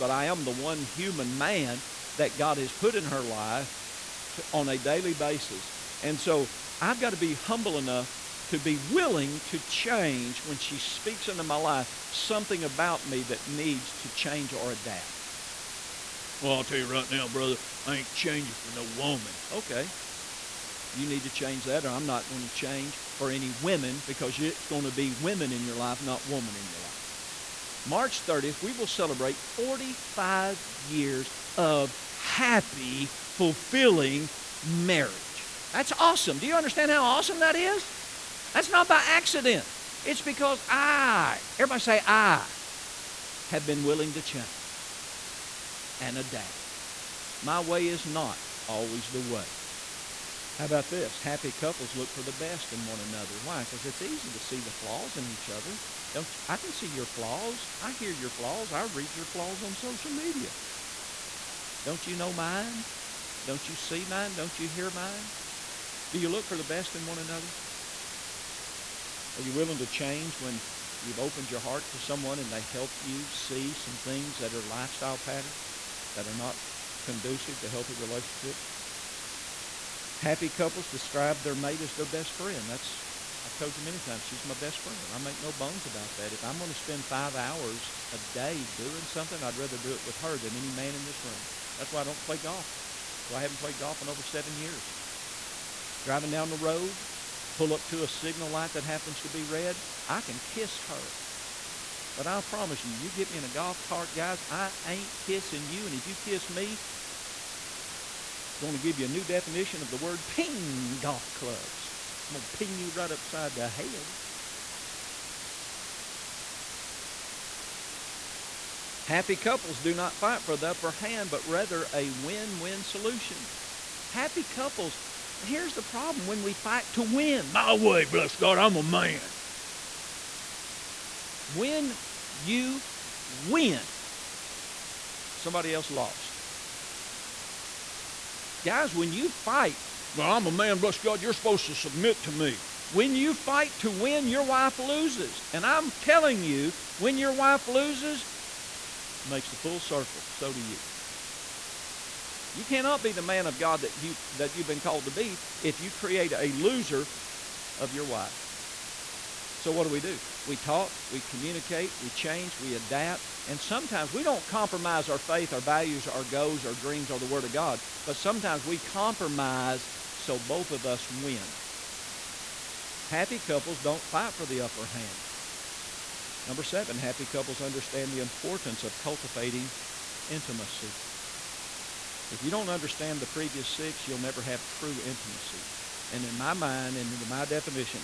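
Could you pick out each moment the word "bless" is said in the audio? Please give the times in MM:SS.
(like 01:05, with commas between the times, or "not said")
02:08, 02:20.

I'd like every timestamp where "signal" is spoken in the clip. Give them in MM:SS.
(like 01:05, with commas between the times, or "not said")
01:38.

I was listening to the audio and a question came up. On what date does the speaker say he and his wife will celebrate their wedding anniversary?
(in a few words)
March 30.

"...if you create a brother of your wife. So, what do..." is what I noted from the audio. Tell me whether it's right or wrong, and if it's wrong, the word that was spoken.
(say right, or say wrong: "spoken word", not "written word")
wrong: "loser", not "brother".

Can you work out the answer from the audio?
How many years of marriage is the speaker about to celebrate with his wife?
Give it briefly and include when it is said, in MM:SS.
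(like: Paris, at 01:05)
45, at 00:29.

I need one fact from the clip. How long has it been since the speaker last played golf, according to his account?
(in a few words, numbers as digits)
over 7 years.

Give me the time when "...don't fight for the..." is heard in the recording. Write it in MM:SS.
02:53.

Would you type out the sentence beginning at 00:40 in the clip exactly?
It's because I, everybody say, I have been willing to change and adapt.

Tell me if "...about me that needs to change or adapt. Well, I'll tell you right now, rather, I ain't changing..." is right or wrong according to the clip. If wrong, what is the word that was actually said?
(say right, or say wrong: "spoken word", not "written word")
wrong: "brother", not "rather".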